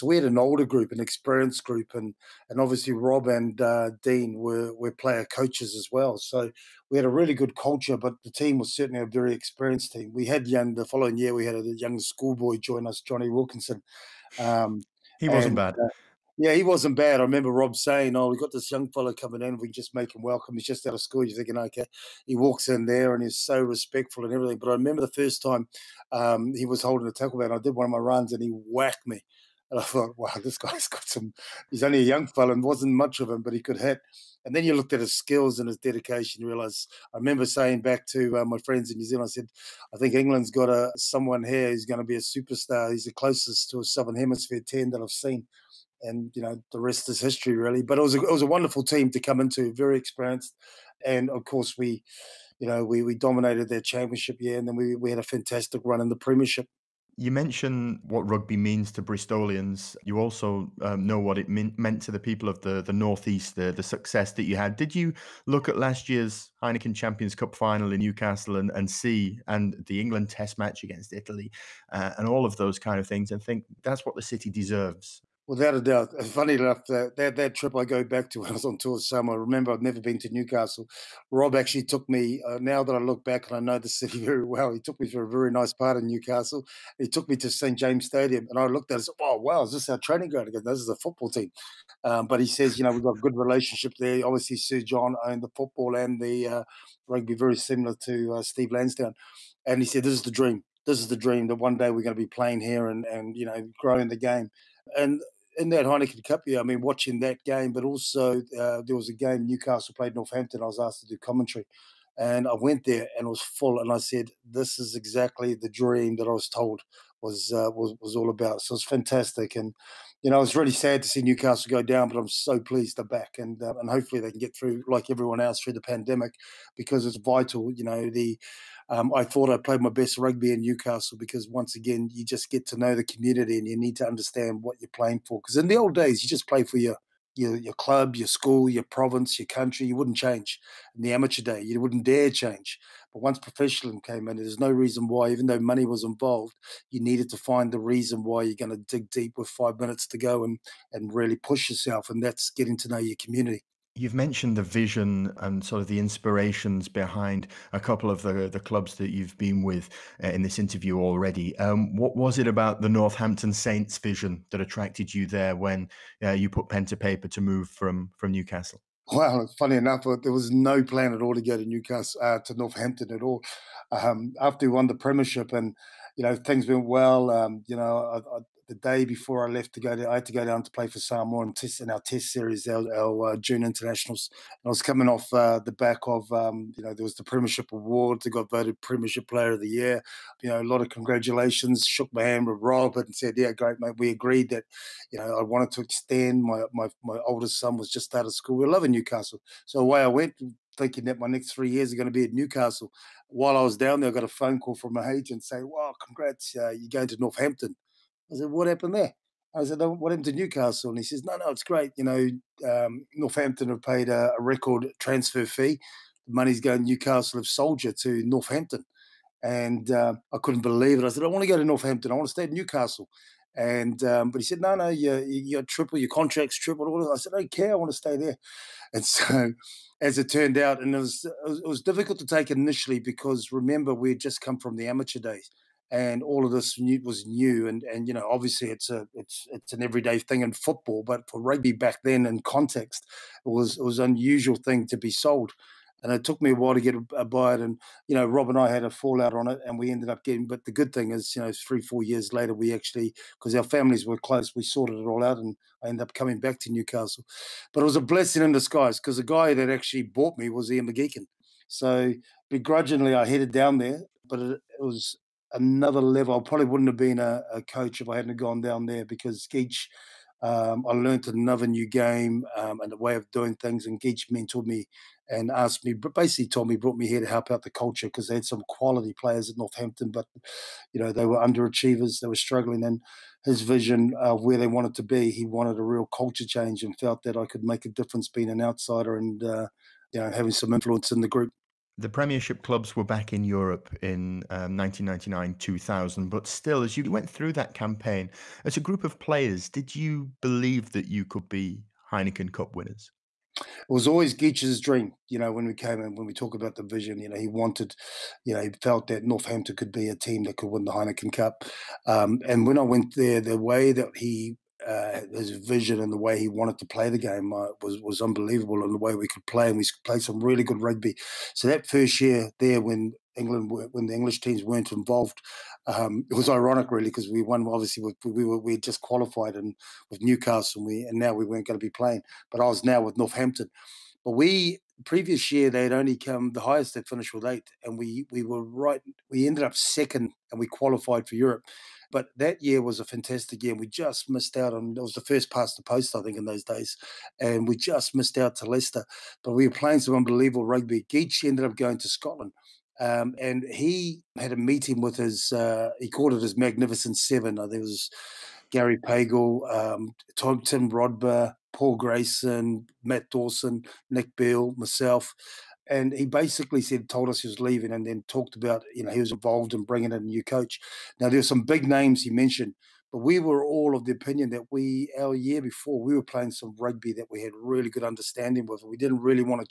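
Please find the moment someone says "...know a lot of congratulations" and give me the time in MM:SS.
03:10.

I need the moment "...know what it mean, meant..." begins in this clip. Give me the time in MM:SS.
01:01.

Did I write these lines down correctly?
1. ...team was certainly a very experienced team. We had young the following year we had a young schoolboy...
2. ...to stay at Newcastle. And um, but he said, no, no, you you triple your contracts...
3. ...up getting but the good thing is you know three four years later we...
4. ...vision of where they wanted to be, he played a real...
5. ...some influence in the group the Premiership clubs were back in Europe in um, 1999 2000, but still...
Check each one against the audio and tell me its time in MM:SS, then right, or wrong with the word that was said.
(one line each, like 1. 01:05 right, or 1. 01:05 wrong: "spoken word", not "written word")
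1. 00:08 right
2. 03:42 right
3. 04:10 right
4. 04:43 wrong: "wanted", not "played"
5. 04:50 right.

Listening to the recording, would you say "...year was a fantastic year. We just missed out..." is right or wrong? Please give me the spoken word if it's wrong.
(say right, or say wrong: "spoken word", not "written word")
right.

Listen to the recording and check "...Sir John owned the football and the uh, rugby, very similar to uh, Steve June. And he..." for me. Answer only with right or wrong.
wrong.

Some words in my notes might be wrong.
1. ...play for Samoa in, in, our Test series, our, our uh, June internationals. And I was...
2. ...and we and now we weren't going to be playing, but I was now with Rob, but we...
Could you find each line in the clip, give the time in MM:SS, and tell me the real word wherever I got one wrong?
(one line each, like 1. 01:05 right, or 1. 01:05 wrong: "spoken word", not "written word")
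1. 03:00 right
2. 05:30 wrong: "Northampton", not "Rob".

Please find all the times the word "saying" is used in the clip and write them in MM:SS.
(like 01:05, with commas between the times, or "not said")
00:17, 00:37, 03:25.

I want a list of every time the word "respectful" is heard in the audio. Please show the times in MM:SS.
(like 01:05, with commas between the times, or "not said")
00:23.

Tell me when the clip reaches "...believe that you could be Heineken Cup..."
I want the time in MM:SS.
05:00.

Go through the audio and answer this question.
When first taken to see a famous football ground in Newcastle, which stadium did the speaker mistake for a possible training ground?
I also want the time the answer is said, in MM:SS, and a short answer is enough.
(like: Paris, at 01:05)
St. James Stadium, at 01:27.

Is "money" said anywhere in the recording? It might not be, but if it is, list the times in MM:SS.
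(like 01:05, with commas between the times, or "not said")
02:25, 03:36.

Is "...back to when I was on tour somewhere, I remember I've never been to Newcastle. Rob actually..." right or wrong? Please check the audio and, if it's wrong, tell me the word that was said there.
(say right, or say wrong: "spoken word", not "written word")
right.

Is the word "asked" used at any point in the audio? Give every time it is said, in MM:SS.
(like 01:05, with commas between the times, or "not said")
01:50, 04:35.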